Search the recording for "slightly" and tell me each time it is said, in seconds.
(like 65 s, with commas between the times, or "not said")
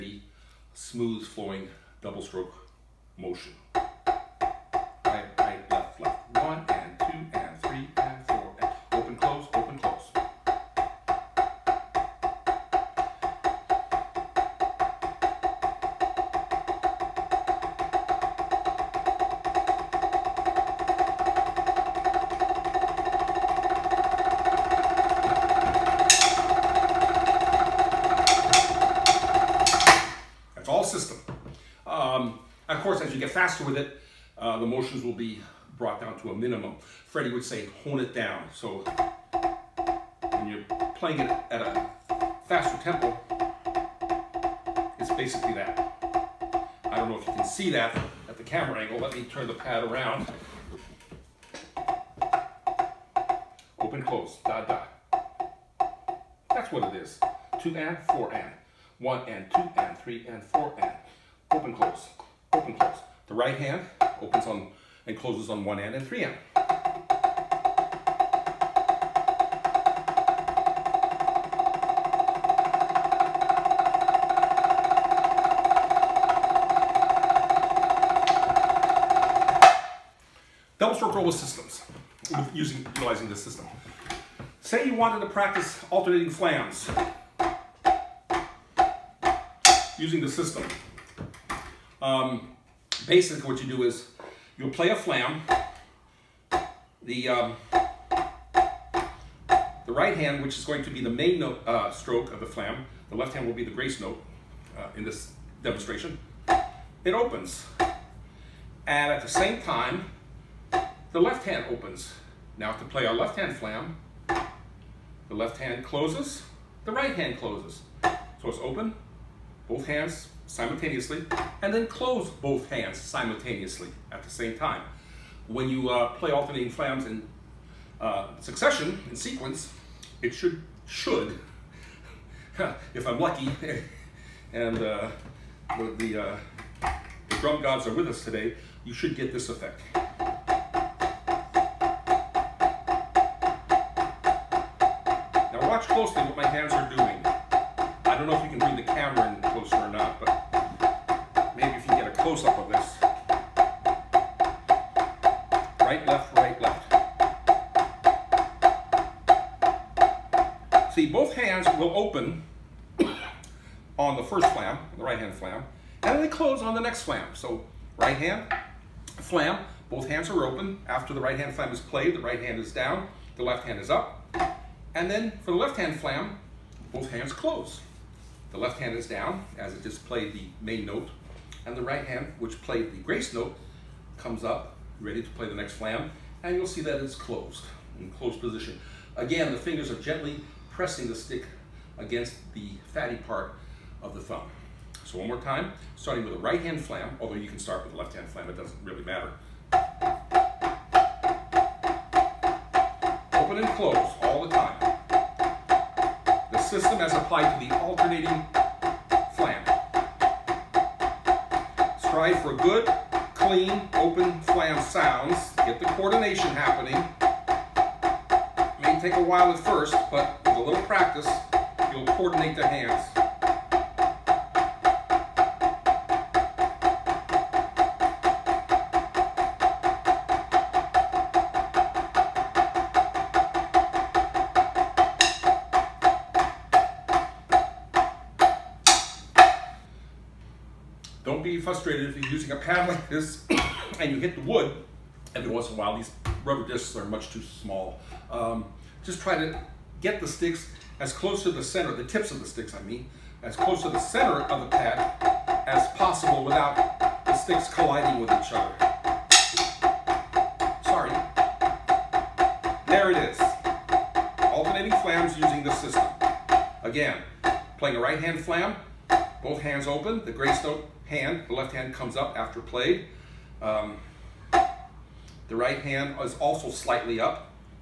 276 s.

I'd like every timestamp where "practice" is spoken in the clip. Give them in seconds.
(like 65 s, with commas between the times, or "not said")
85 s, 220 s.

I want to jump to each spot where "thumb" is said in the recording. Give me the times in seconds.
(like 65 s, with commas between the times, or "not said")
194 s.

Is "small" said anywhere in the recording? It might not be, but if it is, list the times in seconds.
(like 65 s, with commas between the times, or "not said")
247 s.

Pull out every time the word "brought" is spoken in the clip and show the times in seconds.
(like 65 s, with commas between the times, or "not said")
35 s.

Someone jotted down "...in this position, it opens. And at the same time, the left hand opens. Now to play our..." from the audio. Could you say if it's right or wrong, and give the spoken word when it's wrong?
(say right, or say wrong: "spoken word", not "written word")
wrong: "demonstration", not "position".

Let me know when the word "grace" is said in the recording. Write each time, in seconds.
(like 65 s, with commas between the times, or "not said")
103 s, 182 s, 270 s.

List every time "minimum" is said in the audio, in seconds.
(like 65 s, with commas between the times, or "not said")
36 s.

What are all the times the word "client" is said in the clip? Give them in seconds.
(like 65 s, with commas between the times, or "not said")
not said.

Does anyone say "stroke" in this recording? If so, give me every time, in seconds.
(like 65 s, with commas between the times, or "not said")
2 s, 80 s, 101 s.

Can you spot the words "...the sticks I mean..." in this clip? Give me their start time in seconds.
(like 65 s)
252 s.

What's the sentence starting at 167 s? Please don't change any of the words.
So right hand, flam, both hands are open.